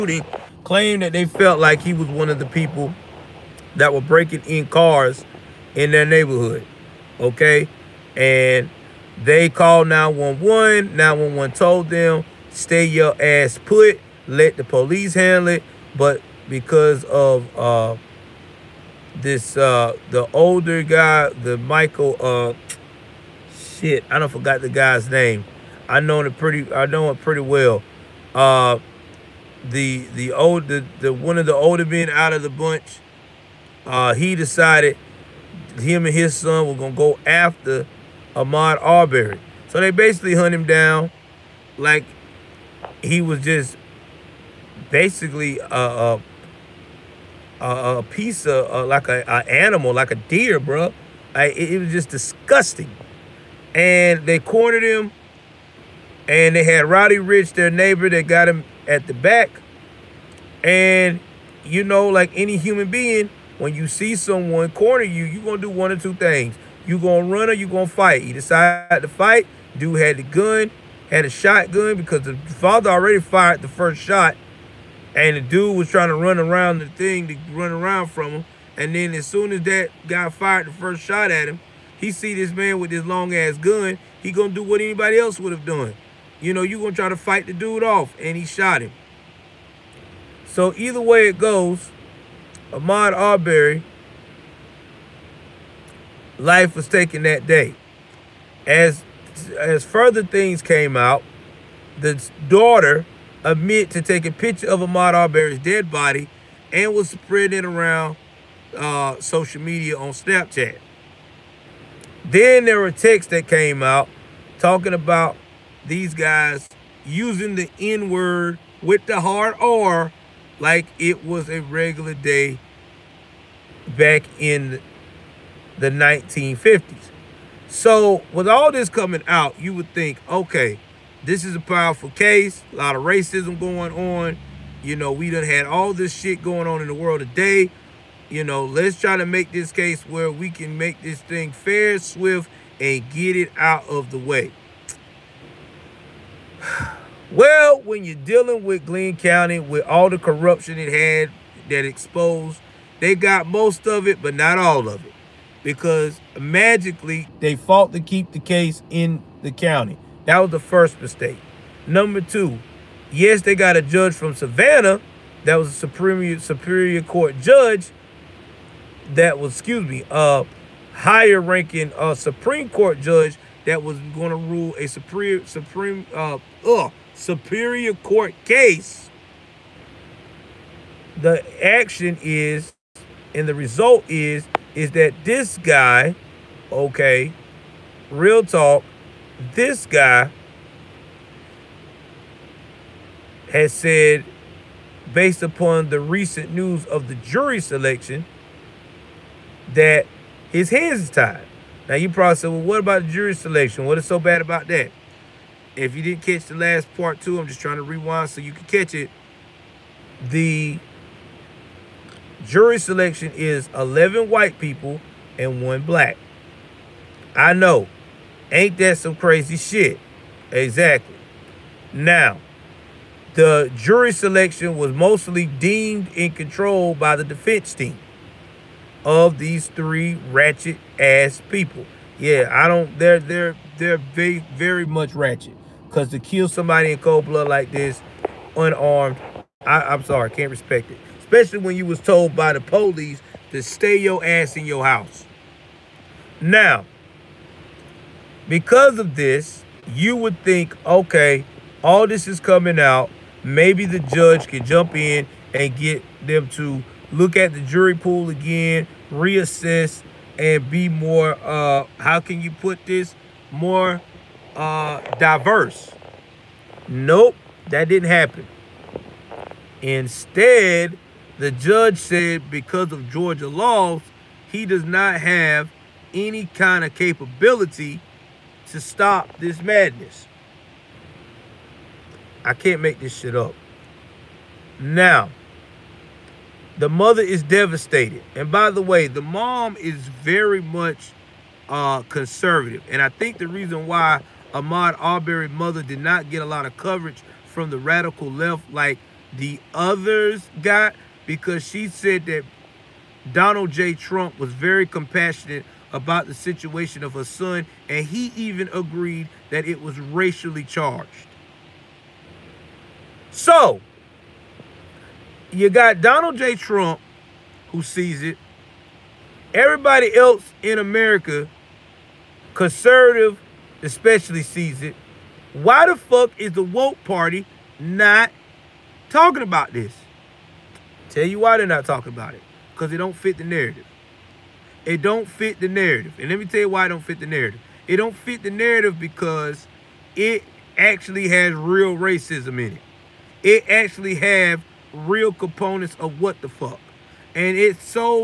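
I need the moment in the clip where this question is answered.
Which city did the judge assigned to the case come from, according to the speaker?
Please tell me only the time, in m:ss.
2:44.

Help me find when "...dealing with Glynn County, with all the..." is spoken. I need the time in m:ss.
2:28.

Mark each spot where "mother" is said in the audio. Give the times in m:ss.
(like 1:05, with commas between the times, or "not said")
4:46, 4:55.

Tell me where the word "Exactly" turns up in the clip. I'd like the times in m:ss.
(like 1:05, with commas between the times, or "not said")
3:40.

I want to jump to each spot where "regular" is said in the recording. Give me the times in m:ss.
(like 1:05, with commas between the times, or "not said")
2:01.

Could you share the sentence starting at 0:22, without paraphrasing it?
Uh, shit, I don't forgot the guy's name.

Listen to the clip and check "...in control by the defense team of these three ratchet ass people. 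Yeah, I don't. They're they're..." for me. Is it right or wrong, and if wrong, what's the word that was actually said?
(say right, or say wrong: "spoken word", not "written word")
right.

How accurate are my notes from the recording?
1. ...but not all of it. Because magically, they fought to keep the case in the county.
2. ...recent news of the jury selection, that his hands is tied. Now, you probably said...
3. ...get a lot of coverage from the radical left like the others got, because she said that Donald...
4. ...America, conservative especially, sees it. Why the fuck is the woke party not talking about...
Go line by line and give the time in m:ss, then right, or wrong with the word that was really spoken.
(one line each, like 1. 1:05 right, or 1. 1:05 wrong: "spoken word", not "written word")
1. 2:34 right
2. 3:15 right
3. 4:56 right
4. 5:20 right.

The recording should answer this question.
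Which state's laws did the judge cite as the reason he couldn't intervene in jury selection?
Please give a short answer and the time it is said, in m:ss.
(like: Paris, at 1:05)
Georgia, at 4:33.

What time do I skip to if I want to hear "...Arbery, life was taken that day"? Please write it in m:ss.
1:33.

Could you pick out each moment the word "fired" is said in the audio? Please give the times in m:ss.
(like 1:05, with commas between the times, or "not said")
1:13, 1:20.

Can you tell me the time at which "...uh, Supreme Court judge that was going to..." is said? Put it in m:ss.
2:51.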